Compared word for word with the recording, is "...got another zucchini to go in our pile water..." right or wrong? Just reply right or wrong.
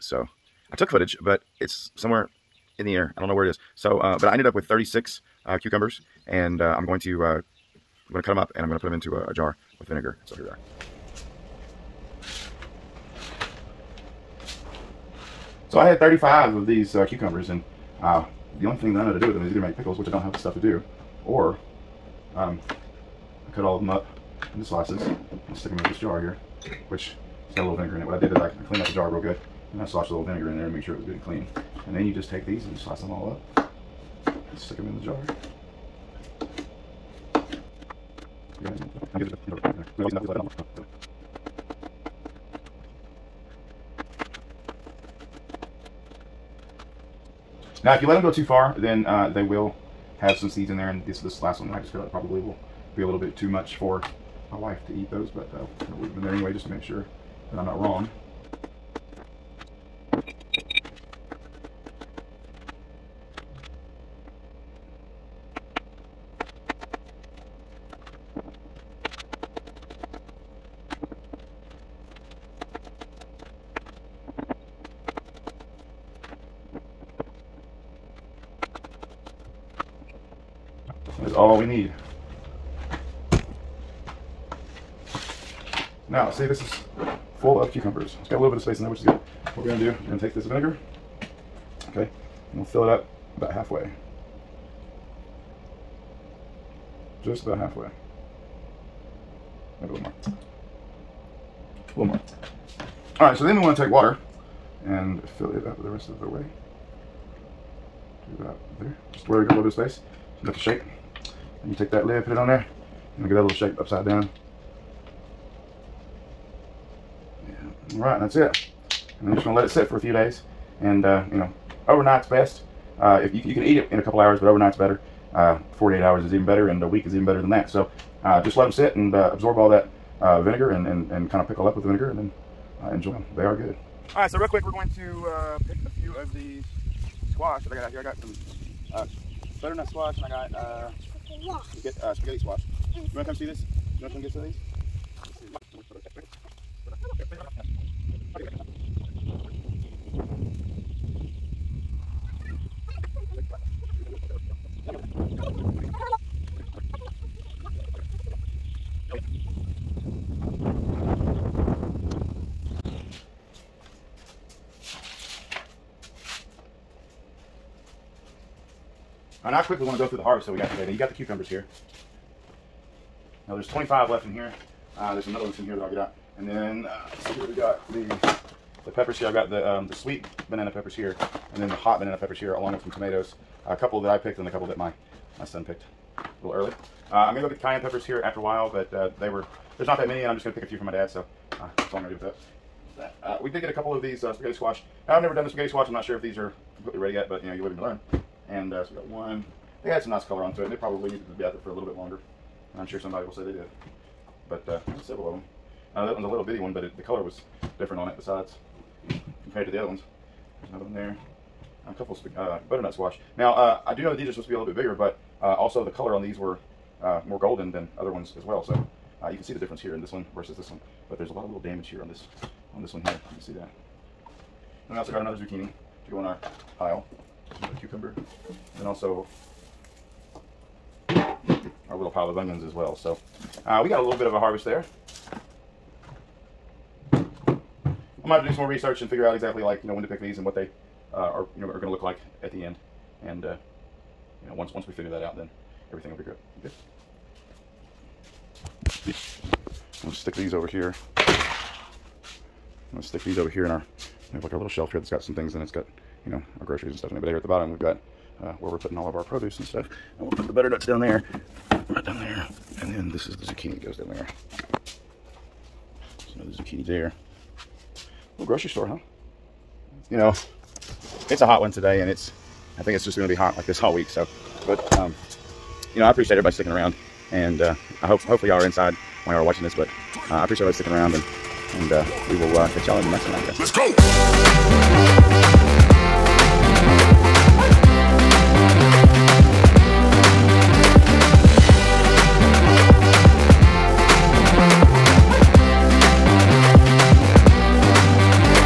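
wrong.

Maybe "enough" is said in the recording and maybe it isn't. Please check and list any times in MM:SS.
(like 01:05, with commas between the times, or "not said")
01:50.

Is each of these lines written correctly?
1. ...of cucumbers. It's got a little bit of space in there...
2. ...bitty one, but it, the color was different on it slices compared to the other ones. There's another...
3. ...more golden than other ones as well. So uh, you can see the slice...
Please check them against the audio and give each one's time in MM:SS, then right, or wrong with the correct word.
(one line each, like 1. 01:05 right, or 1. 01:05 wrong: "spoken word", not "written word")
1. 01:27 right
2. 03:26 wrong: "besides", not "slices"
3. 03:37 wrong: "difference", not "slice".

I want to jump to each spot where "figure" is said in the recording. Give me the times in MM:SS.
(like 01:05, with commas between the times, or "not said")
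03:59, 04:04.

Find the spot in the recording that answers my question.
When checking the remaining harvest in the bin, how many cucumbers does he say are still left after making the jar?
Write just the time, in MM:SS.
02:53.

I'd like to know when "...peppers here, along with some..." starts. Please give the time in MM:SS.
03:02.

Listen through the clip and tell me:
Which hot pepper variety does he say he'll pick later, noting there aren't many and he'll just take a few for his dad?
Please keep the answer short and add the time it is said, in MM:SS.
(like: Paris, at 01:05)
cayenne, at 03:07.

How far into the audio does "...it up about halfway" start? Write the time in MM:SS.
01:32.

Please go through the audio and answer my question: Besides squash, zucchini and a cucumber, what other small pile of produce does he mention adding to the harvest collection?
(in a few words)
onions.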